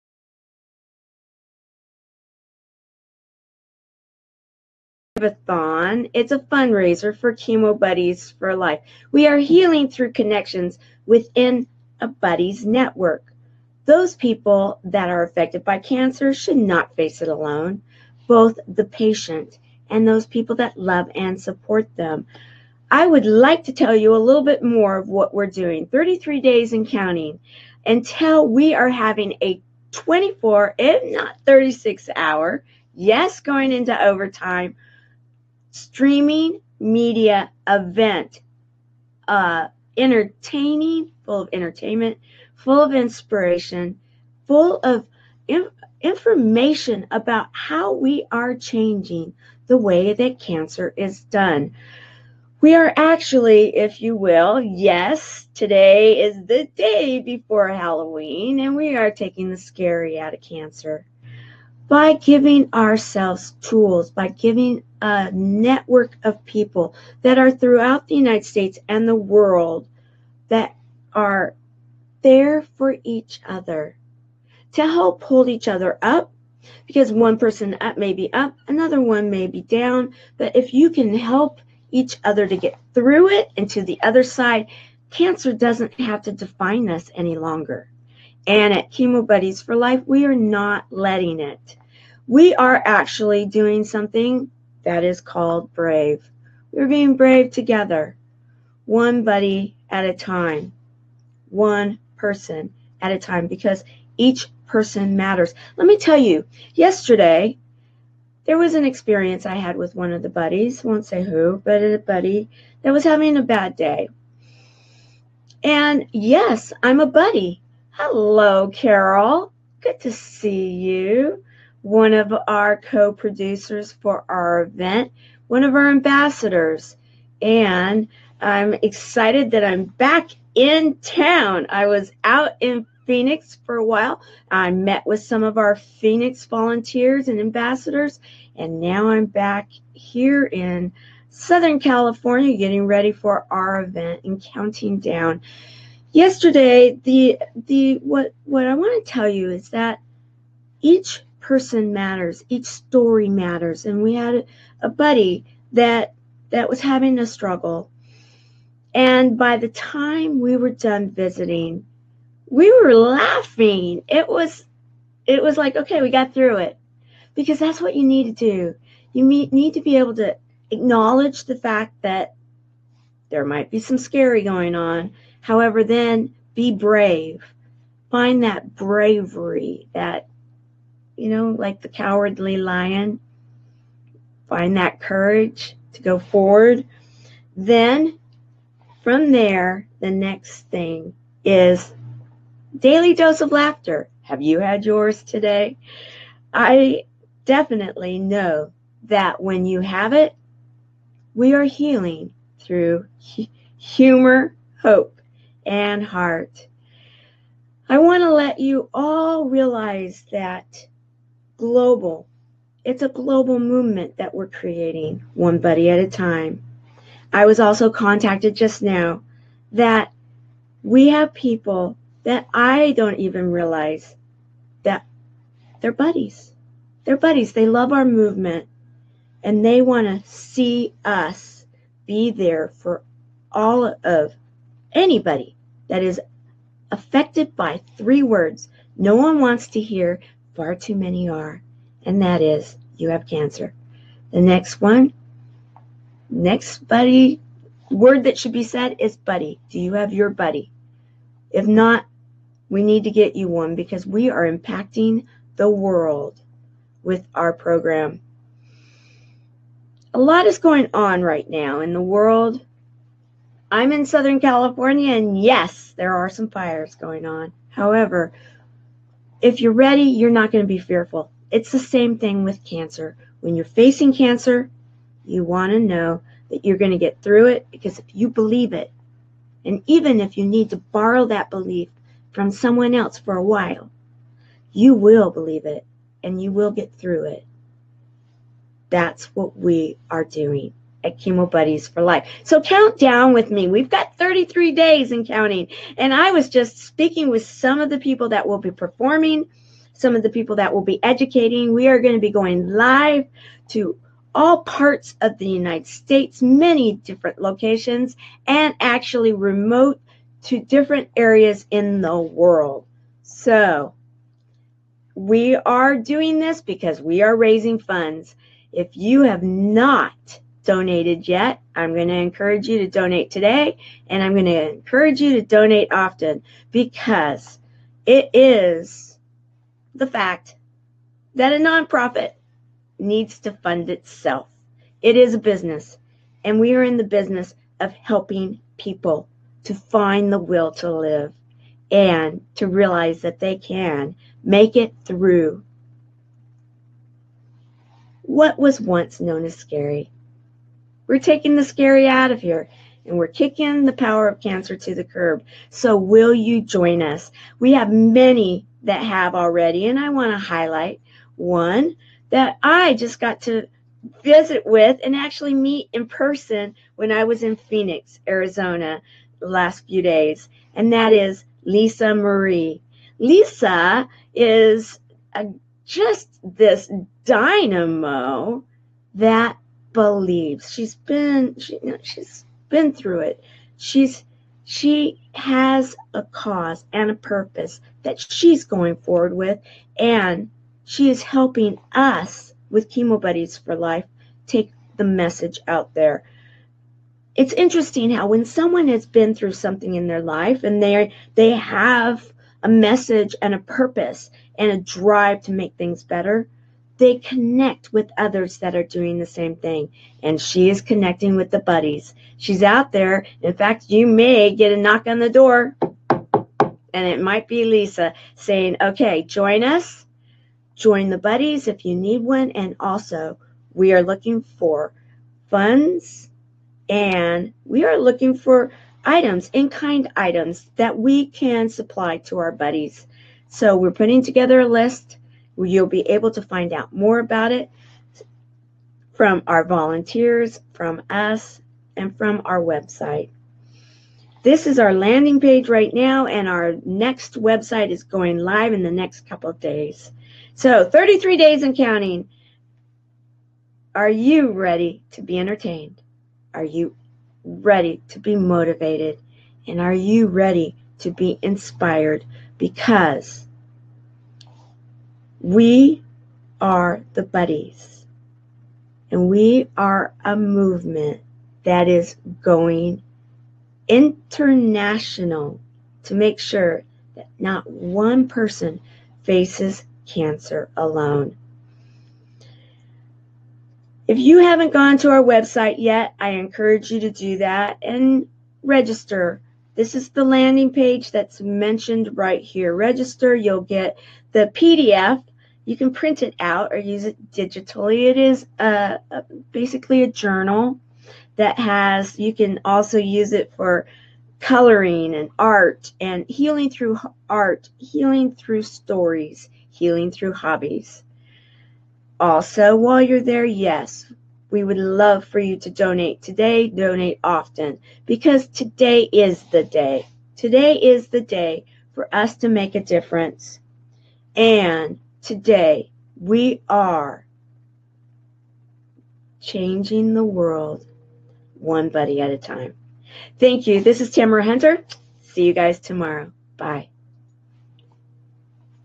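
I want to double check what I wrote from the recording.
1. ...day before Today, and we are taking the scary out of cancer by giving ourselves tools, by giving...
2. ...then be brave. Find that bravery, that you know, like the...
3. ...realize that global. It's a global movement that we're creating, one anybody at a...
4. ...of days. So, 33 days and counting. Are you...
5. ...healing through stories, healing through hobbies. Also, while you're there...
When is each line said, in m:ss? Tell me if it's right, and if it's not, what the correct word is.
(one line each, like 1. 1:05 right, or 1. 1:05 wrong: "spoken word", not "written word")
1. 0:56 wrong: "Halloween", not "Today"
2. 2:55 right
3. 3:29 wrong: "buddy", not "anybody"
4. 7:29 right
5. 8:27 right.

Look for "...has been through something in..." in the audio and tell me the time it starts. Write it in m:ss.
6:38.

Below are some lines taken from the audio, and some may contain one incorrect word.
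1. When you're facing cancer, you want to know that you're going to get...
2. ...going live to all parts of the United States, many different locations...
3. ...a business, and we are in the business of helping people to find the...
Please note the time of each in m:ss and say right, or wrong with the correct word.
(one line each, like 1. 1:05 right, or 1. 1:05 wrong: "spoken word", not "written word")
1. 4:33 right
2. 5:02 right
3. 5:35 right.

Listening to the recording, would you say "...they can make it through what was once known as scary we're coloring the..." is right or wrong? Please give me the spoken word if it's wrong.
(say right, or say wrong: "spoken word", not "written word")
wrong: "taking", not "coloring".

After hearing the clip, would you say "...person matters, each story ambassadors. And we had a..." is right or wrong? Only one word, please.
wrong.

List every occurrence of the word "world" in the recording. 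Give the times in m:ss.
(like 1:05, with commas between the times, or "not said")
1:09, 4:15, 4:22, 5:12, 8:50.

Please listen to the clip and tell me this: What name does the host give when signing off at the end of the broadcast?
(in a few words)
Tamara Hunter.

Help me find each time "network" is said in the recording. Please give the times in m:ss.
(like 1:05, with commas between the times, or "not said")
0:12, 1:05.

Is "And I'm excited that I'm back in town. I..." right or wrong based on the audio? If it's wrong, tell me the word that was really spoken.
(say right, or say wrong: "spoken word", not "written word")
right.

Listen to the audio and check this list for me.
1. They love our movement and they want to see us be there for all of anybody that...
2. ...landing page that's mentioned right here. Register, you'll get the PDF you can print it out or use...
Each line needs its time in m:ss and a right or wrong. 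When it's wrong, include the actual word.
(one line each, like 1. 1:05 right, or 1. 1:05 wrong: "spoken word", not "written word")
1. 3:47 right
2. 8:10 right.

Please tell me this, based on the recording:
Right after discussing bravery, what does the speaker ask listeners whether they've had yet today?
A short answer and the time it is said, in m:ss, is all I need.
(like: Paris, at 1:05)
daily dose of laughter, at 3:12.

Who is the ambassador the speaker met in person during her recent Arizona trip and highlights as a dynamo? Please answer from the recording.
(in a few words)
Lisa Marie.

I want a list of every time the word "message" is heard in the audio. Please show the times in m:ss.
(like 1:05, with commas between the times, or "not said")
6:35, 6:42.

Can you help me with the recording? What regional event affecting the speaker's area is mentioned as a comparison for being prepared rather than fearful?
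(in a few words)
fires.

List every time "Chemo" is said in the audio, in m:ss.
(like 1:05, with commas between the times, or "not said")
0:07, 1:28, 4:51, 6:32.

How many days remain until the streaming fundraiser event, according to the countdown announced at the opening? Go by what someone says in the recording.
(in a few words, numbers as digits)
33.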